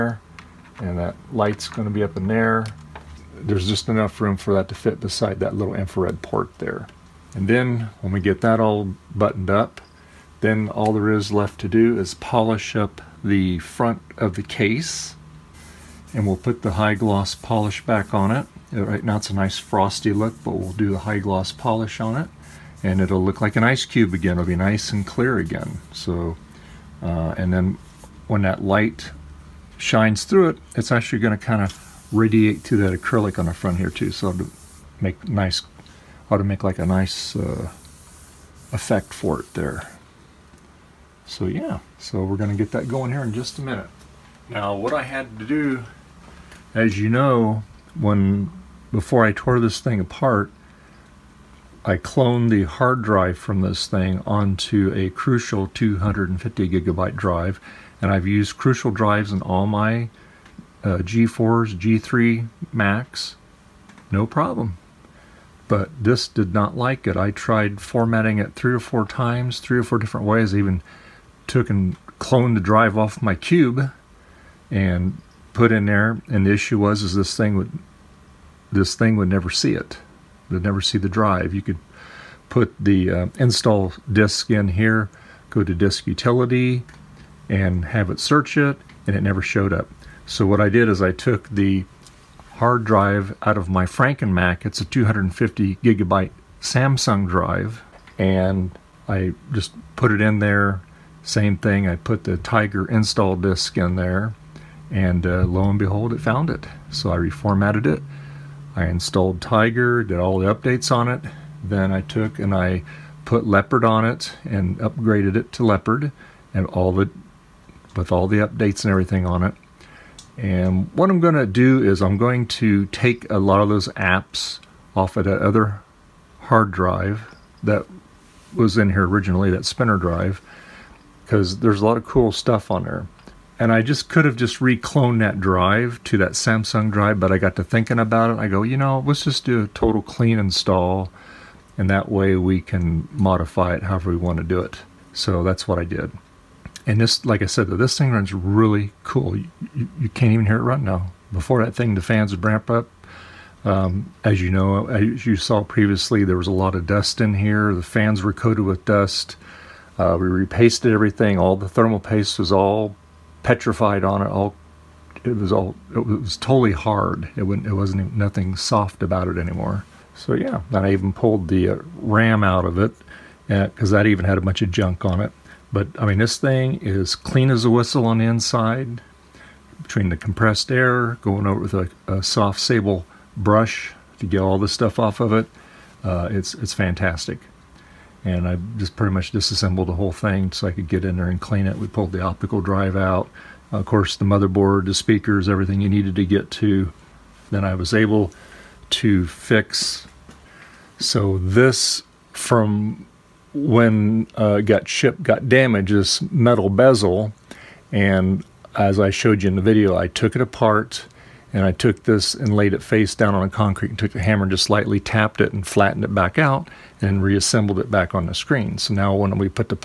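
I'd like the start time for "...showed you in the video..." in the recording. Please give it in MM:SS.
03:29.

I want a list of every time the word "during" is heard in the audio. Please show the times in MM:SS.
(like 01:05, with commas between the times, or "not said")
not said.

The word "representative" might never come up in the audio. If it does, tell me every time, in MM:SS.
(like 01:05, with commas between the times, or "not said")
not said.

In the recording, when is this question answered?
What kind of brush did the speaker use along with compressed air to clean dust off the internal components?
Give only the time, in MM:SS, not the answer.
03:02.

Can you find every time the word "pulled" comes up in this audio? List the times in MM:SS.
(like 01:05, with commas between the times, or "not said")
02:51, 03:11.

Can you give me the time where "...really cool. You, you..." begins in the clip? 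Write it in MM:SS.
02:28.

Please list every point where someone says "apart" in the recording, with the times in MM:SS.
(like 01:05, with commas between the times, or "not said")
00:49, 03:30.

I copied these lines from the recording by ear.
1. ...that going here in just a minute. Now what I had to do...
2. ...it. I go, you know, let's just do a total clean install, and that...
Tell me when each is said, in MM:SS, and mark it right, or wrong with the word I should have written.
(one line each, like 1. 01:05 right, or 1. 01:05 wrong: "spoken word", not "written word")
1. 00:42 right
2. 02:18 right.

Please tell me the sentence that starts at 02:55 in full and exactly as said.
But I mean, this thing is clean as a whistle on the inside.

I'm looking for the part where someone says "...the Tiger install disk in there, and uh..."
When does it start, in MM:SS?
01:42.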